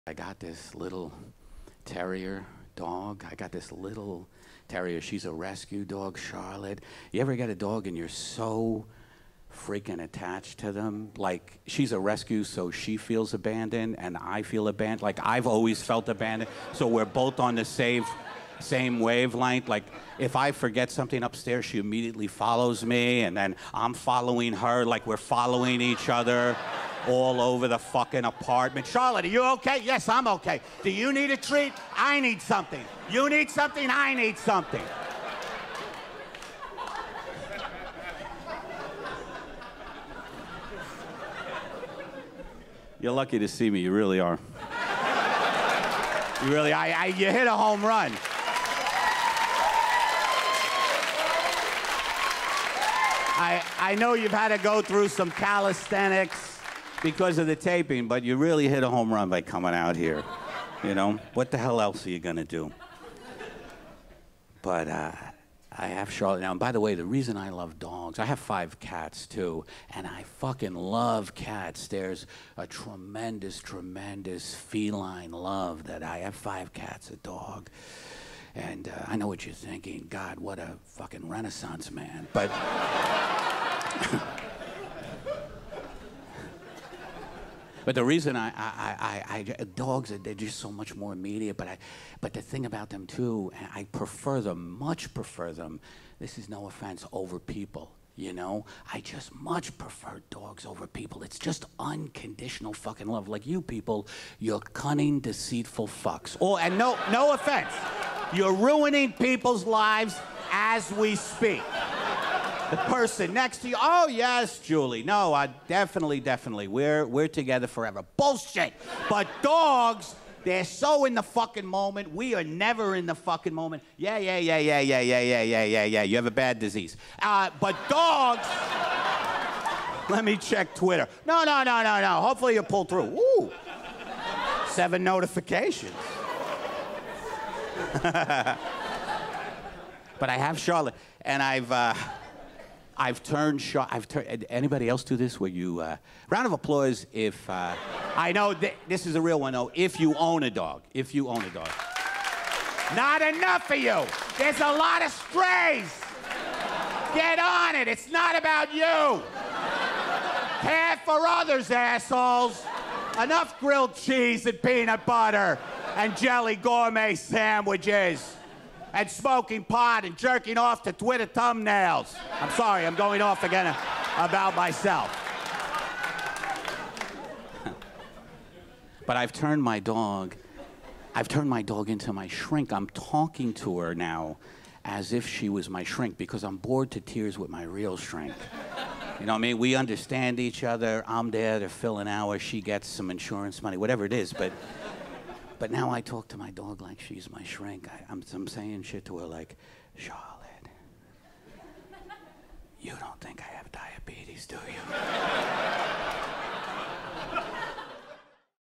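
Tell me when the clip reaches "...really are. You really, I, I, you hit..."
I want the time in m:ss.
0:43.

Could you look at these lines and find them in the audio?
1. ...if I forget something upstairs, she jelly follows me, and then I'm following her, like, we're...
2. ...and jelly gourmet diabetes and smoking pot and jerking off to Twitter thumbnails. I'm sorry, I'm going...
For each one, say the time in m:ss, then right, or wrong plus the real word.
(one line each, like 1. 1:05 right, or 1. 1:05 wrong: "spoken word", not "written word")
1. 0:20 wrong: "immediately", not "jelly"
2. 2:45 wrong: "sandwiches", not "diabetes".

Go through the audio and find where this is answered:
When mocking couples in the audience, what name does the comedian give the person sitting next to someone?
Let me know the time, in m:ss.
1:54.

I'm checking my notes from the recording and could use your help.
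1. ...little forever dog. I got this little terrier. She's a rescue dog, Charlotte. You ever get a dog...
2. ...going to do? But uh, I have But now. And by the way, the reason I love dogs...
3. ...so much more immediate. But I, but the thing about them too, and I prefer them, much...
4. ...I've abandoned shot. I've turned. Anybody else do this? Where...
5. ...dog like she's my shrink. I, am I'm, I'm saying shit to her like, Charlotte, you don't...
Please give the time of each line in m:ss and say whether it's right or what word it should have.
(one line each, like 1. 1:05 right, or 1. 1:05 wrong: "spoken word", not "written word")
1. 0:00 wrong: "terrier", not "forever"
2. 1:02 wrong: "Charlotte", not "But"
3. 1:30 right
4. 2:22 wrong: "turned", not "abandoned"
5. 3:16 right.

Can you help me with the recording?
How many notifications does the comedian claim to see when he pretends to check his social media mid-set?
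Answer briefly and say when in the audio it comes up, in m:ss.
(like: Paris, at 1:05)
7, at 2:14.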